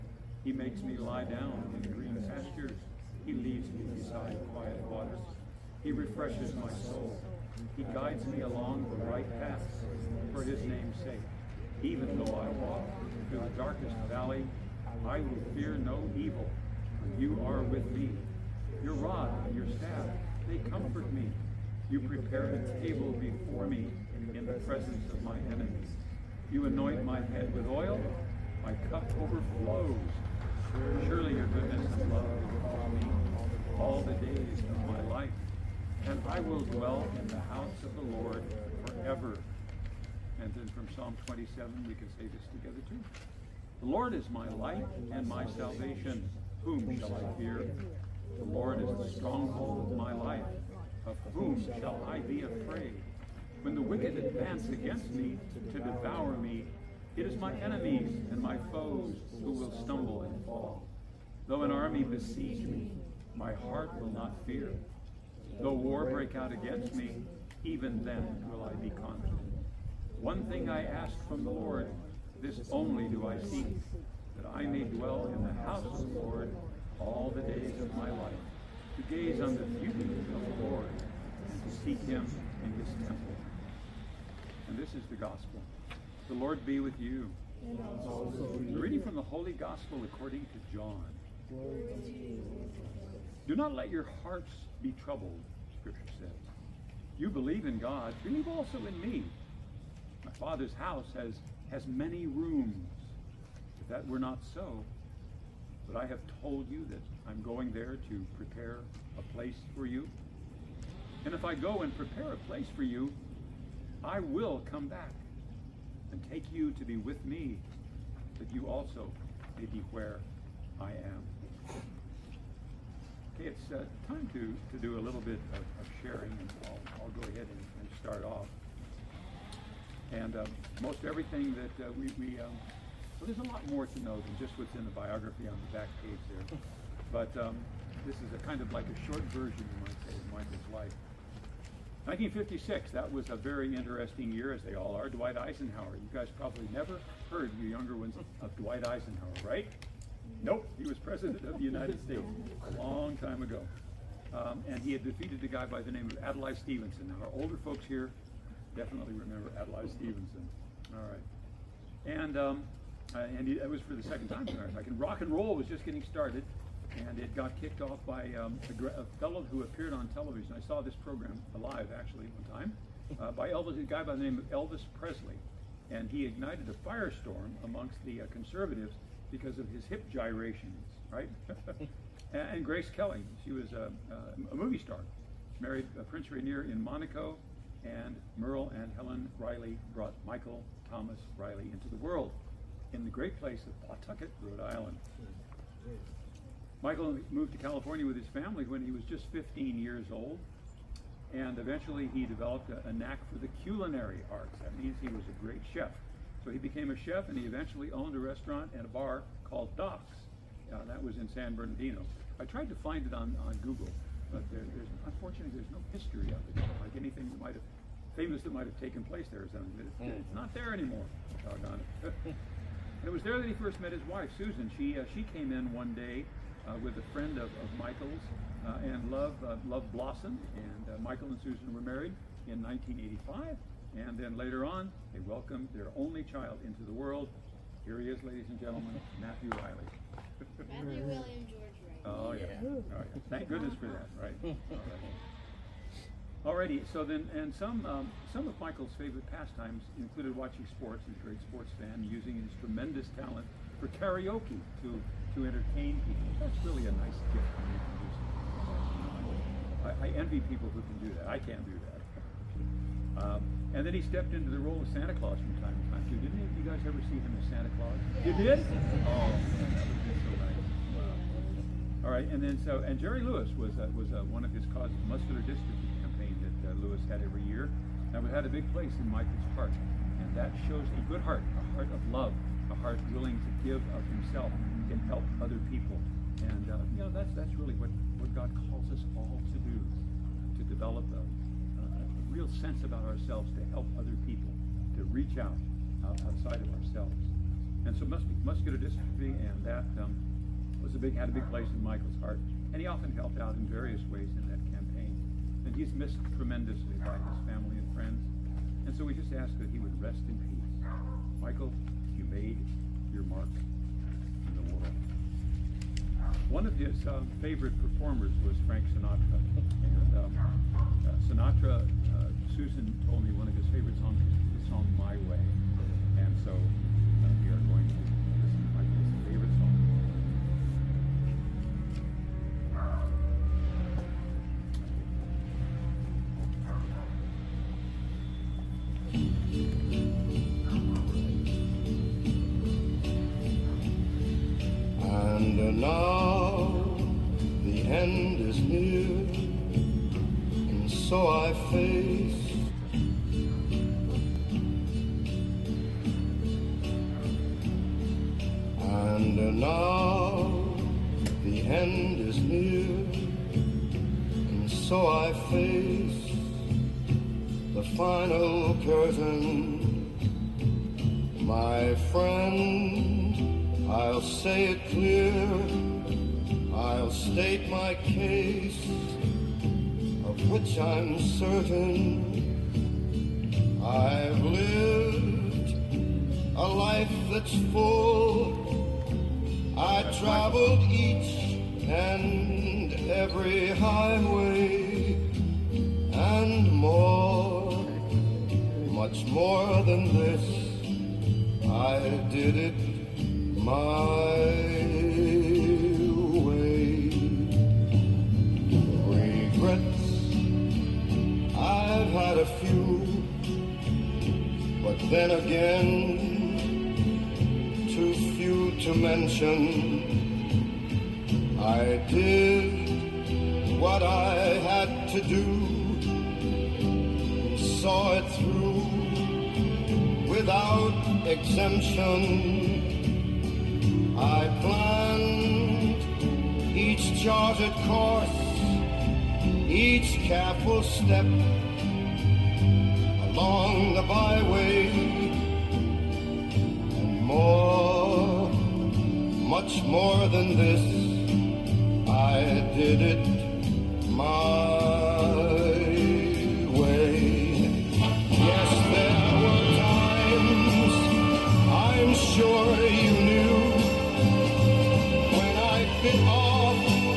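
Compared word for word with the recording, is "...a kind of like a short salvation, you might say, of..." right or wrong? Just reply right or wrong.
wrong.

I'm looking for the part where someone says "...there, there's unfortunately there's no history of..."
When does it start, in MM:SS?
03:34.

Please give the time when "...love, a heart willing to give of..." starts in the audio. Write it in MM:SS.
04:42.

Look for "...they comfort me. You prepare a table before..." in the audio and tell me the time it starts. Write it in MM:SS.
00:20.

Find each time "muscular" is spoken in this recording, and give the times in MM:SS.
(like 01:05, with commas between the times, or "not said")
04:35, 04:58.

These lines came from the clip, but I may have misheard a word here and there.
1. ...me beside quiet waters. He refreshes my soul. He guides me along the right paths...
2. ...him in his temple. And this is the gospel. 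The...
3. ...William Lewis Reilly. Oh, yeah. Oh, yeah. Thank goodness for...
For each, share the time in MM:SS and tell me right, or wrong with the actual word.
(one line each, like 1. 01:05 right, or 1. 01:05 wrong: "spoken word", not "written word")
1. 00:03 right
2. 01:22 right
3. 04:01 wrong: "George", not "Lewis".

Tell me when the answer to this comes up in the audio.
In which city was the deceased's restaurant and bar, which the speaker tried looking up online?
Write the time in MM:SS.
03:31.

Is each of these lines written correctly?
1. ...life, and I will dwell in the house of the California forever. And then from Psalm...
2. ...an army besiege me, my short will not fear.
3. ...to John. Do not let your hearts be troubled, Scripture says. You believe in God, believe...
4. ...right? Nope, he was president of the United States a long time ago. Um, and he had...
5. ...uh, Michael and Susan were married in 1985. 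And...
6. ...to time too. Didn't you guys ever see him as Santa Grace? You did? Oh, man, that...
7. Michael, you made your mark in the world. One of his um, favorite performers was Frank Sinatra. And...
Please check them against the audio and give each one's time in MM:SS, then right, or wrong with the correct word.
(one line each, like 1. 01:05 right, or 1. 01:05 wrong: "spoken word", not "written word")
1. 00:35 wrong: "Lord", not "California"
2. 01:01 wrong: "heart", not "short"
3. 01:30 right
4. 02:29 right
5. 03:50 right
6. 04:25 wrong: "Claus", not "Grace"
7. 05:11 right.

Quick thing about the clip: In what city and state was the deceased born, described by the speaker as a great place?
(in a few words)
Pawtucket, Rhode Island.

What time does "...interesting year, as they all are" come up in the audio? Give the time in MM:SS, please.
02:23.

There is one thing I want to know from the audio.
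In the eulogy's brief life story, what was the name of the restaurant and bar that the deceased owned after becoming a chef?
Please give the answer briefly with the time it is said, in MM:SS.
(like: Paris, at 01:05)
Doc's, at 03:29.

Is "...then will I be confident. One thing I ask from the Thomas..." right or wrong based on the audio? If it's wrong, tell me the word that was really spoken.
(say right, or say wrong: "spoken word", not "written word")
wrong: "Lord", not "Thomas".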